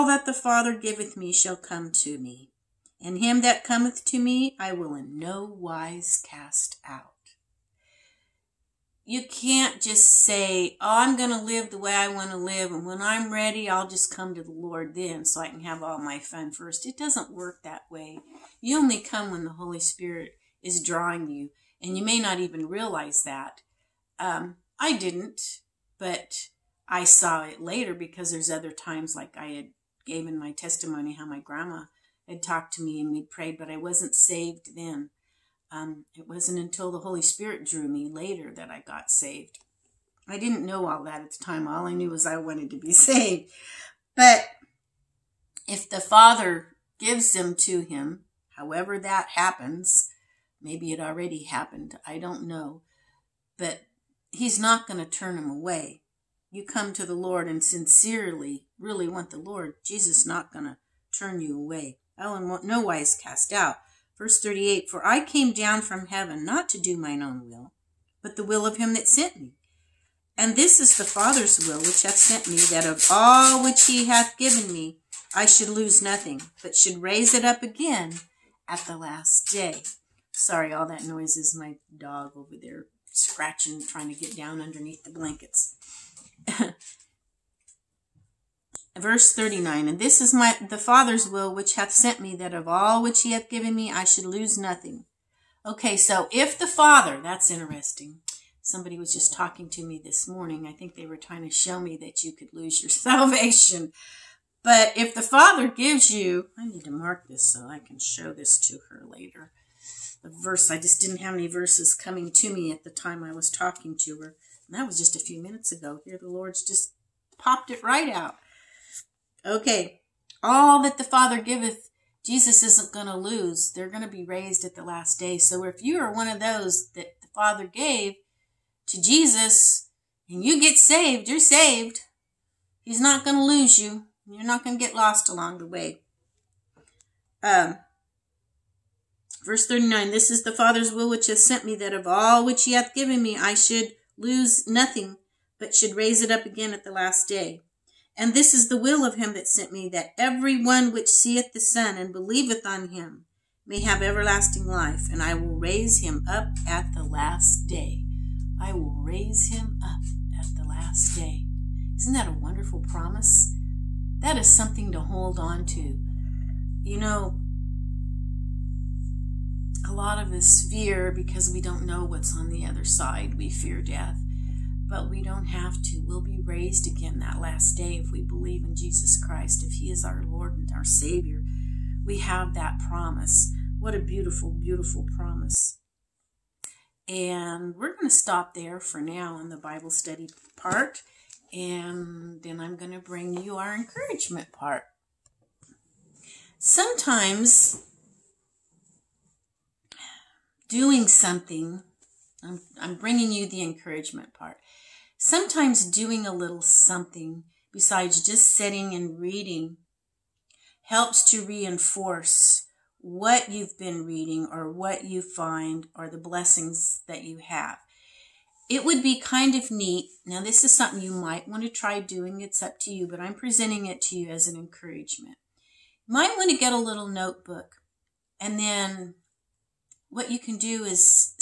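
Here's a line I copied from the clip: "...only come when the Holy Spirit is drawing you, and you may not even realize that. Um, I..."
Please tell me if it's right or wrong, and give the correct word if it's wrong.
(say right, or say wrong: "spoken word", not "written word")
right.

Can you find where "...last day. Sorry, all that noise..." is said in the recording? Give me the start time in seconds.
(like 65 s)
78 s.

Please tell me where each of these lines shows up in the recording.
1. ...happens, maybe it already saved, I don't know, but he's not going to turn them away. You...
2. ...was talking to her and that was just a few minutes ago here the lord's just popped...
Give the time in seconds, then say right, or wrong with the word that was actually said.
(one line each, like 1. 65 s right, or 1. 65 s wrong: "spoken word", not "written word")
1. 49 s wrong: "happened", not "saved"
2. 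113 s right.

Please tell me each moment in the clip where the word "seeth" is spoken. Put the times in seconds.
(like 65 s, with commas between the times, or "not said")
151 s.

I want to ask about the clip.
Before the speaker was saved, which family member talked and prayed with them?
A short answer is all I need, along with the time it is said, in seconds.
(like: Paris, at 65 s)
Grandma, at 31 s.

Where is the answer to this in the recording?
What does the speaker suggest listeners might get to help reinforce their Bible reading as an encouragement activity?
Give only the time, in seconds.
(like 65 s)
226 s.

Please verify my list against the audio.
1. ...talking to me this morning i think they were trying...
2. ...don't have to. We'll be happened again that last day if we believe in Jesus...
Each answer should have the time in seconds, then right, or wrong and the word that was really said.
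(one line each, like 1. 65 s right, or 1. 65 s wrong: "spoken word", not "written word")
1. 99 s right
2. 175 s wrong: "raised", not "happened".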